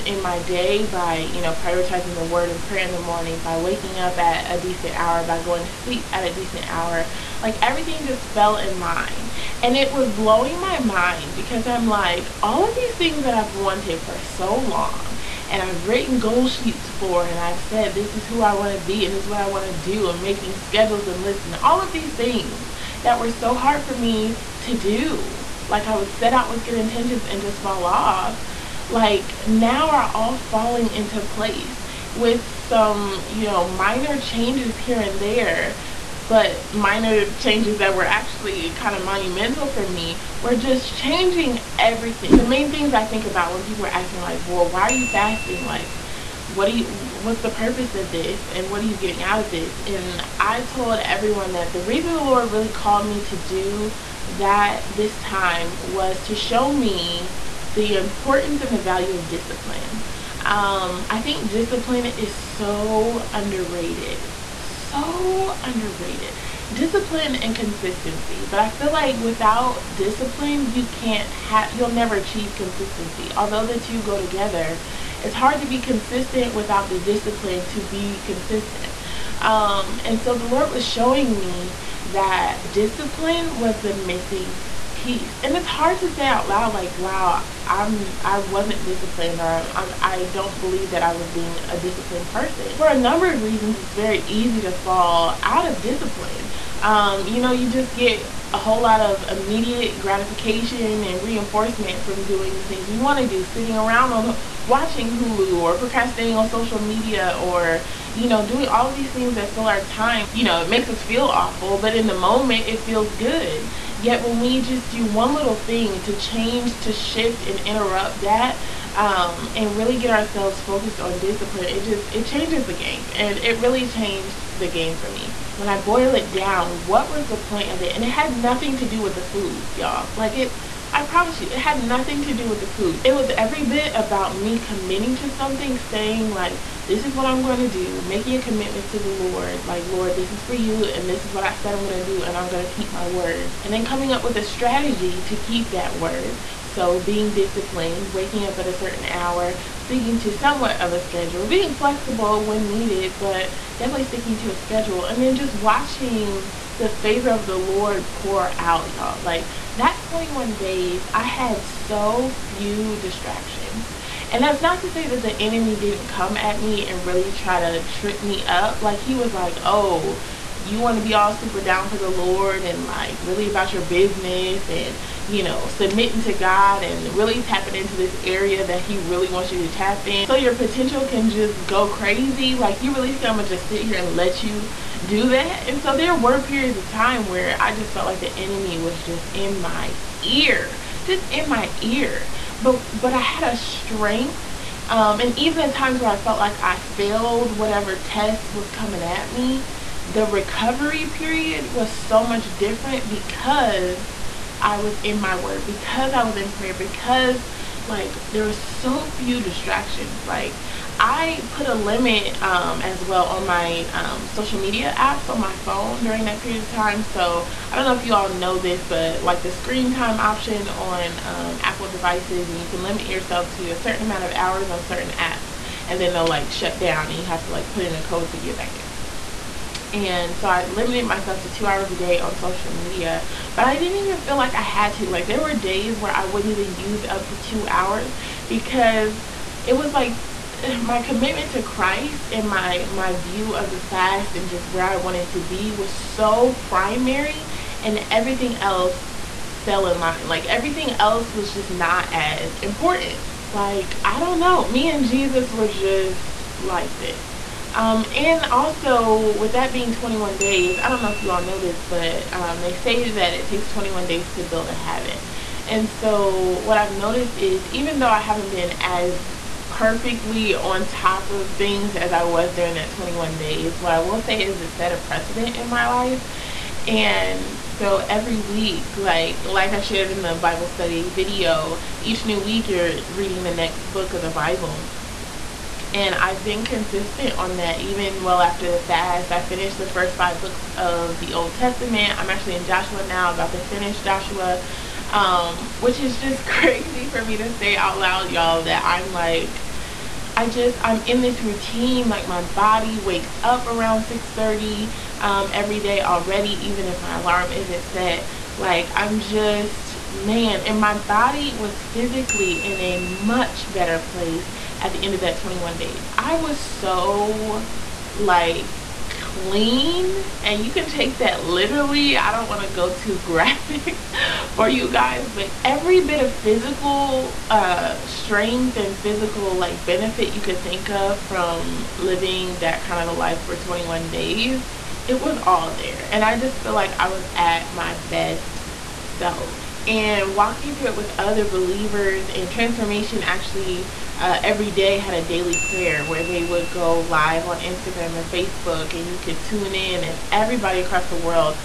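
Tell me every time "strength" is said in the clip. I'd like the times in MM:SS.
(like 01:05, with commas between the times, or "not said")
03:13, 05:28.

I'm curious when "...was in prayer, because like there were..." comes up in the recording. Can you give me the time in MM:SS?
03:26.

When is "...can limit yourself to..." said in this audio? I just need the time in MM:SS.
03:42.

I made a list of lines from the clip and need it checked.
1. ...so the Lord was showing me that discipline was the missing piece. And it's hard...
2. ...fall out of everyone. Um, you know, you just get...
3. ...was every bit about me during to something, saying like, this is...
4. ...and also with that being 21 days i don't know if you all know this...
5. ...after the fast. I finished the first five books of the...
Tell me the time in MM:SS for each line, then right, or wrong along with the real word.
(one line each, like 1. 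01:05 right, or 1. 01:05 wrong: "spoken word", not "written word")
1. 01:20 right
2. 01:34 wrong: "discipline", not "everyone"
3. 02:13 wrong: "committing", not "during"
4. 04:18 right
5. 04:48 right.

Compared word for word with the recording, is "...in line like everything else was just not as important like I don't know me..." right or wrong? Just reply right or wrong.
right.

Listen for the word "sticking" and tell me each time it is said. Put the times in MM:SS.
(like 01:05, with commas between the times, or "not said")
02:29, 02:34.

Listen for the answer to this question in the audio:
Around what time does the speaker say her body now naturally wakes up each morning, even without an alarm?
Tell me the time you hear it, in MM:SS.
05:04.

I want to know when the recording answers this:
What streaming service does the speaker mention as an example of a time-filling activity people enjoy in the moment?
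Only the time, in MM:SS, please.
01:44.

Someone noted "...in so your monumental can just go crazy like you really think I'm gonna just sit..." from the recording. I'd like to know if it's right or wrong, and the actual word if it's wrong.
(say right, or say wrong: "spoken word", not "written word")
wrong: "potential", not "monumental".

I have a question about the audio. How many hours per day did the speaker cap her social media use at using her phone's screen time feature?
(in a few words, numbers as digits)
2.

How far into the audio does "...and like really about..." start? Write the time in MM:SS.
02:52.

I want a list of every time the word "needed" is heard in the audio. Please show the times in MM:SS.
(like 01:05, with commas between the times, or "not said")
02:32.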